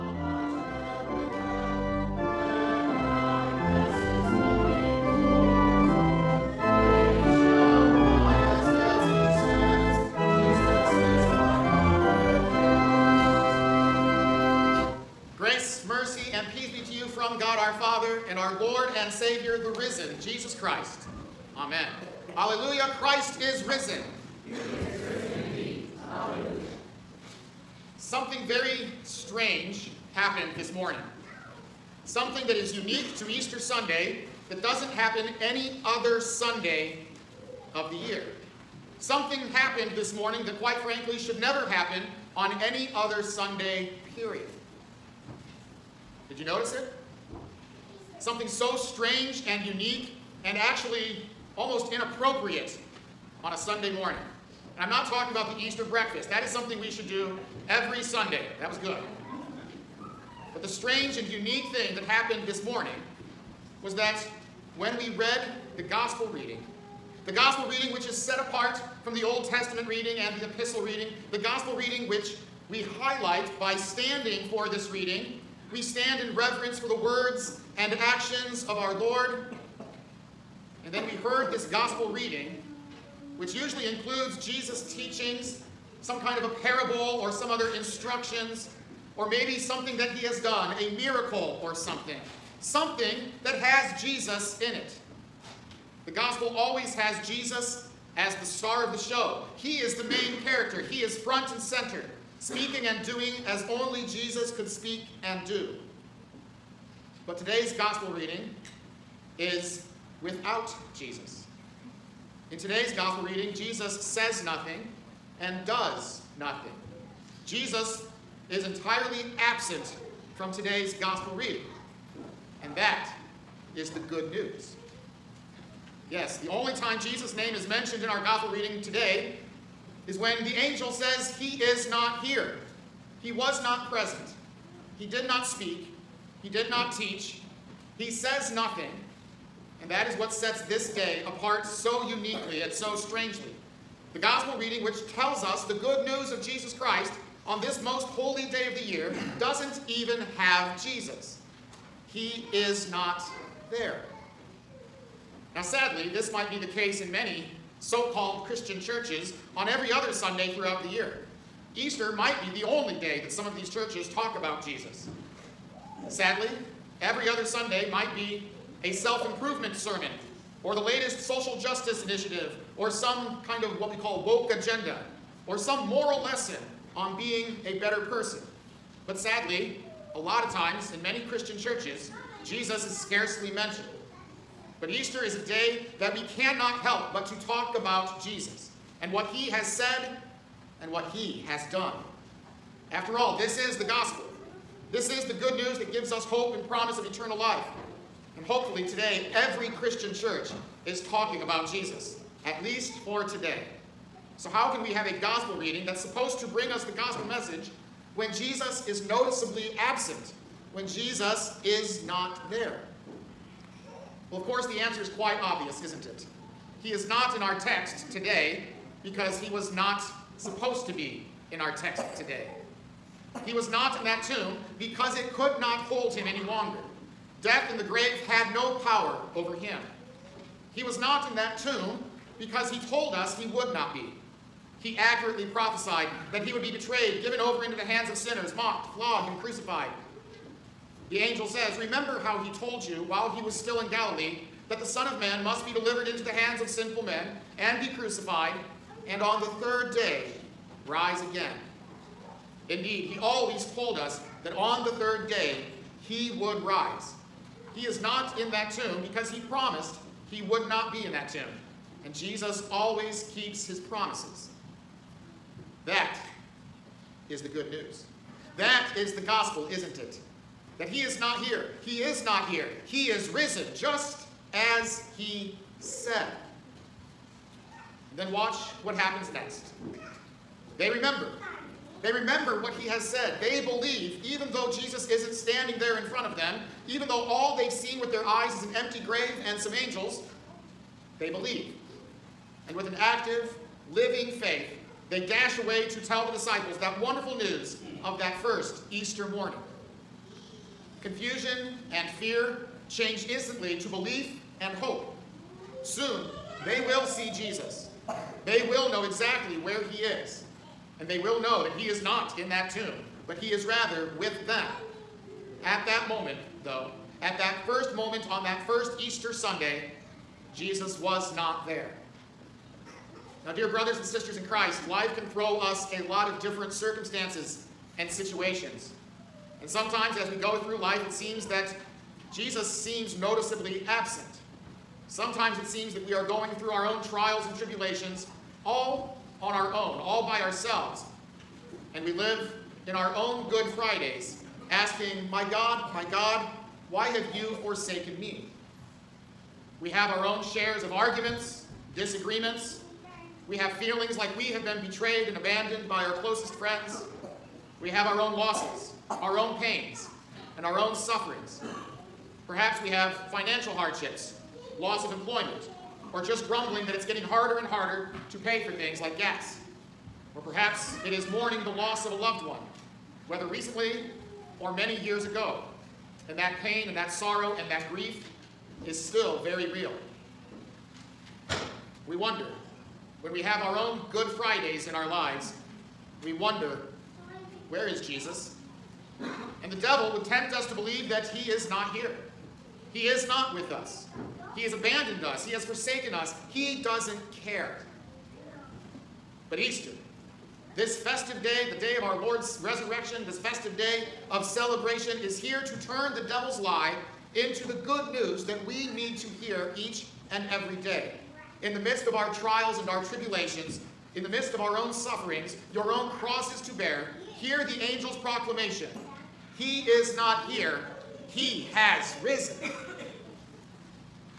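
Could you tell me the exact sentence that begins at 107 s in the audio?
But today's gospel reading is without Jesus.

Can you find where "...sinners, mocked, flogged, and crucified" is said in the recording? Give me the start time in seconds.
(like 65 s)
238 s.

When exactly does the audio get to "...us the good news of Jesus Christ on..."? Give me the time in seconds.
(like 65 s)
145 s.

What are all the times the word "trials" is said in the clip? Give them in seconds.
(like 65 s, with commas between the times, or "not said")
337 s, 412 s.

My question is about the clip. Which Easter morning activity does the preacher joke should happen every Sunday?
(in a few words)
Easter breakfast.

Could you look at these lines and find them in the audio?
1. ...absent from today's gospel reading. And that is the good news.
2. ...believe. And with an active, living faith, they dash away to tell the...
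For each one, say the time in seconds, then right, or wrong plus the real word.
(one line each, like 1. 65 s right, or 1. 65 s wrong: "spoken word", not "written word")
1. 119 s right
2. 291 s right.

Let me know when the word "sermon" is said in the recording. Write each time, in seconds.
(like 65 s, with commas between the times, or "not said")
169 s.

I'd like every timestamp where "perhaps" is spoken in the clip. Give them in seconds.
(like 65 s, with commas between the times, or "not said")
362 s, 370 s.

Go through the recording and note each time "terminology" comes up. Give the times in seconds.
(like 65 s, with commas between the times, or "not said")
not said.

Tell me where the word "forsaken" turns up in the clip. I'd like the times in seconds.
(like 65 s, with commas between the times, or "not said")
347 s, 395 s.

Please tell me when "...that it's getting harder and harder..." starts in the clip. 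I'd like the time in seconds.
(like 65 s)
366 s.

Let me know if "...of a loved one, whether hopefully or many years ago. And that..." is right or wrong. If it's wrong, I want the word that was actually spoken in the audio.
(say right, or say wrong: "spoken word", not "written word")
wrong: "recently", not "hopefully".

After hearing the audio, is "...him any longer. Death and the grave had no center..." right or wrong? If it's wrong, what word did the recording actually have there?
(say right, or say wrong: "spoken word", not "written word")
wrong: "power", not "center".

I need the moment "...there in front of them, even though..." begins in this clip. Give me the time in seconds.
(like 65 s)
285 s.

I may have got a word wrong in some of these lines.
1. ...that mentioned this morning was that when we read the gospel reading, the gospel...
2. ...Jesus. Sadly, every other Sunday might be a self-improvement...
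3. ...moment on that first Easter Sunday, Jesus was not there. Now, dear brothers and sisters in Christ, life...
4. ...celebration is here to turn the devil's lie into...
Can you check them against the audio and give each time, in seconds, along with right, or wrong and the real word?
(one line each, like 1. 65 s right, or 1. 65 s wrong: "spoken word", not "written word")
1. 61 s wrong: "happened", not "mentioned"
2. 164 s right
3. 317 s right
4. 404 s right.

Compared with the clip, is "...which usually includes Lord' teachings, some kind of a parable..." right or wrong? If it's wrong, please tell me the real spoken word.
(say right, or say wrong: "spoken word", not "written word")
wrong: "Jesus", not "Lord".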